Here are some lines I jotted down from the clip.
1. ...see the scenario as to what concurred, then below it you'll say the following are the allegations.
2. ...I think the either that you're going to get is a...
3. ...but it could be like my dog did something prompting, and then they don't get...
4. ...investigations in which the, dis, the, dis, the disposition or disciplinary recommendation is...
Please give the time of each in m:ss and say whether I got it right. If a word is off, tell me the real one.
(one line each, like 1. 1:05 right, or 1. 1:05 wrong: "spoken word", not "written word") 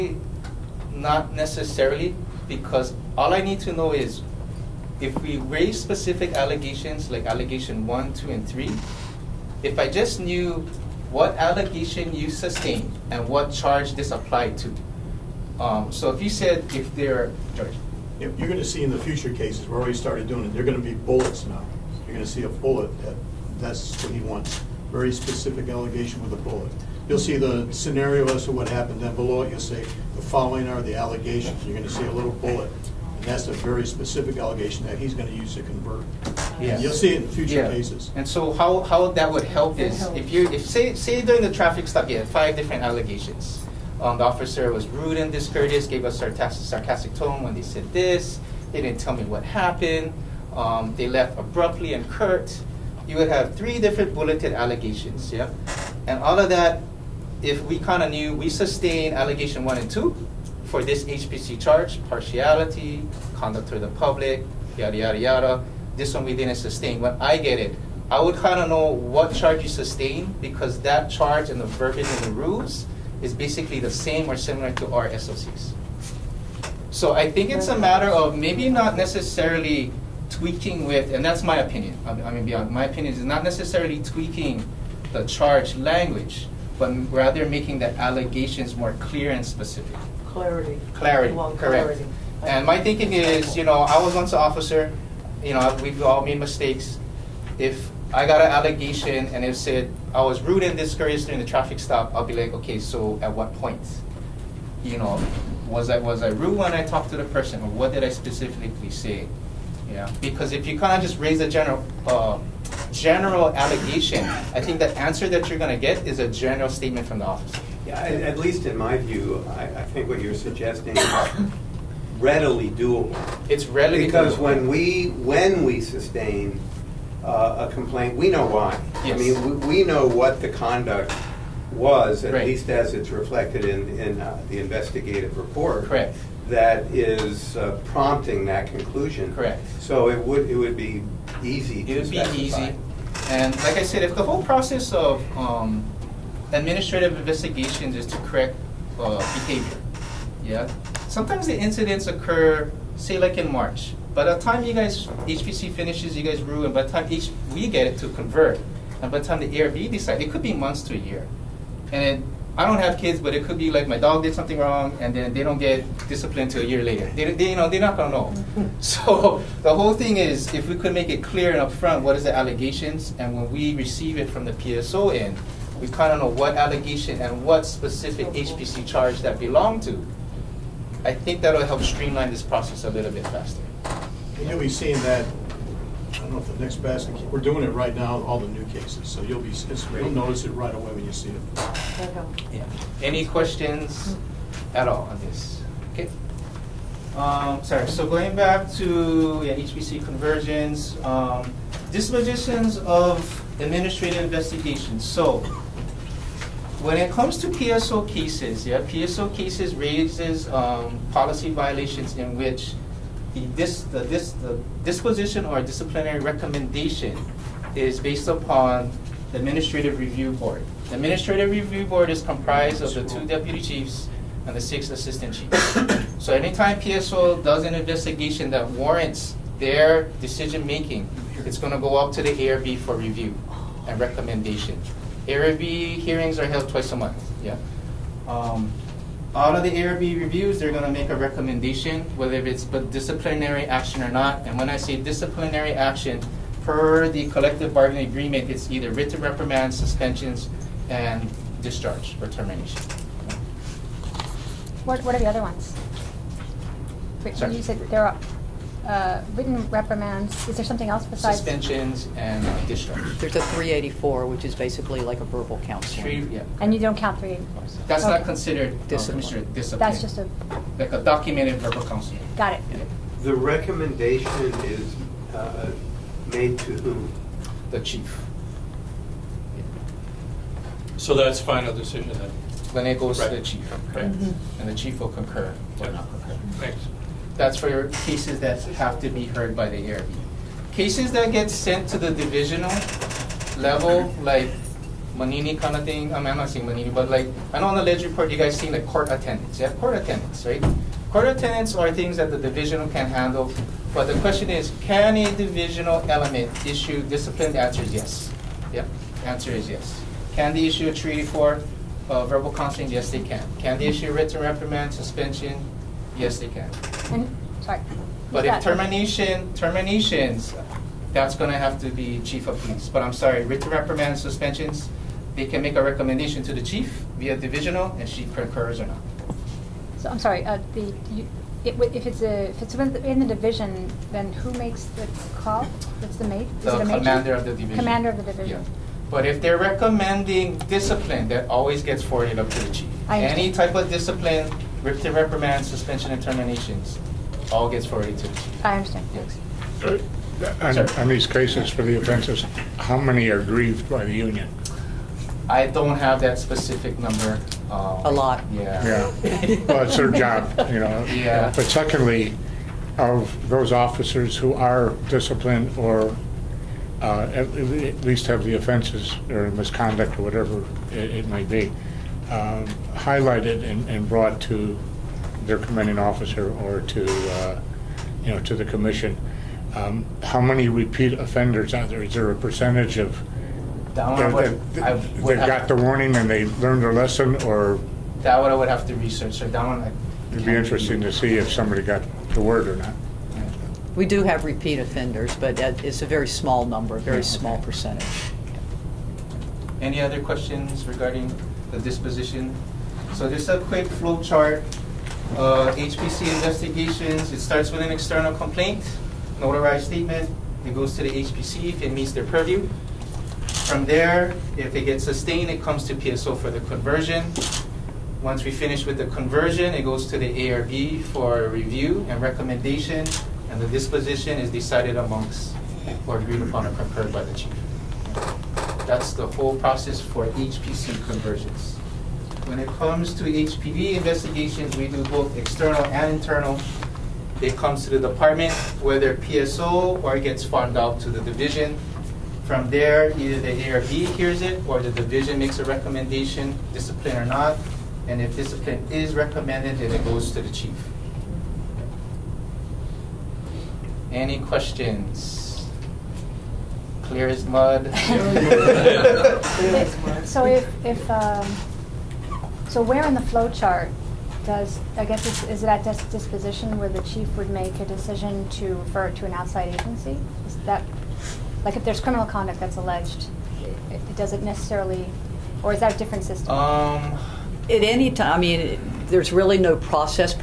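1. 0:27 wrong: "happened", not "concurred"
2. 1:54 wrong: "answer", not "either"
3. 2:43 wrong: "wrong", not "prompting"
4. 3:31 wrong: "violations", not "investigations".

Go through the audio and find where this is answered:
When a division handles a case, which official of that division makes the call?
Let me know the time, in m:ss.
5:37.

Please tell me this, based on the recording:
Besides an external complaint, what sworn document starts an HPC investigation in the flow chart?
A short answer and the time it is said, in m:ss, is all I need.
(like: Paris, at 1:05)
Notarized statement, at 6:49.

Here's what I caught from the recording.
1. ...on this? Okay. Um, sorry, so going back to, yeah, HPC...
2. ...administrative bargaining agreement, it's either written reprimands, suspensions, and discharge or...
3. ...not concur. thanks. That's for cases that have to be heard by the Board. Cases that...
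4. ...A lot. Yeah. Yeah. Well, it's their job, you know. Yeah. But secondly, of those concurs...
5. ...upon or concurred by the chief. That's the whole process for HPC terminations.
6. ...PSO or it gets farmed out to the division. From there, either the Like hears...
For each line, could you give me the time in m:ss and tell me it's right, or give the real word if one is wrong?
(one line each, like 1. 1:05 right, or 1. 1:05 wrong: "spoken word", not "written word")
1. 3:15 right
2. 4:07 wrong: "collective", not "administrative"
3. 4:45 wrong: "ARB", not "Board"
4. 5:58 wrong: "officers", not "concurs"
5. 7:06 wrong: "conversions", not "terminations"
6. 7:19 wrong: "ARB", not "Like".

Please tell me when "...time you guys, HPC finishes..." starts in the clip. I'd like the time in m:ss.
2:34.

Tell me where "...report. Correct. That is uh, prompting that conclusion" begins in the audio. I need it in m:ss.
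2:15.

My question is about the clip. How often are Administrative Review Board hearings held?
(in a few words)
Twice a month.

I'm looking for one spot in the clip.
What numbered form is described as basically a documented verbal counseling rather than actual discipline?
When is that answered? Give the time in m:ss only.
4:23.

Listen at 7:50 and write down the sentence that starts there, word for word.
Is that like if there's criminal conduct that's alleged, it, it does necessarily, or is that a different system?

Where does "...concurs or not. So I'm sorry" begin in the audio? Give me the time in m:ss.
5:28.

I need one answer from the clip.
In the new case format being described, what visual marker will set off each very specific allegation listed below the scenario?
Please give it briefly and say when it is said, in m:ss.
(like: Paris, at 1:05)
Bullets, at 0:20.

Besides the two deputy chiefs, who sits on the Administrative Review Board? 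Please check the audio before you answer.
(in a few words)
Six assistant chiefs.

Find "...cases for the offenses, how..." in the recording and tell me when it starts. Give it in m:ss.
5:51.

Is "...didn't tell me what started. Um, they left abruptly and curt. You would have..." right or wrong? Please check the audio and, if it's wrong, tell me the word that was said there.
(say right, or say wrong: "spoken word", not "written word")
wrong: "happened", not "started".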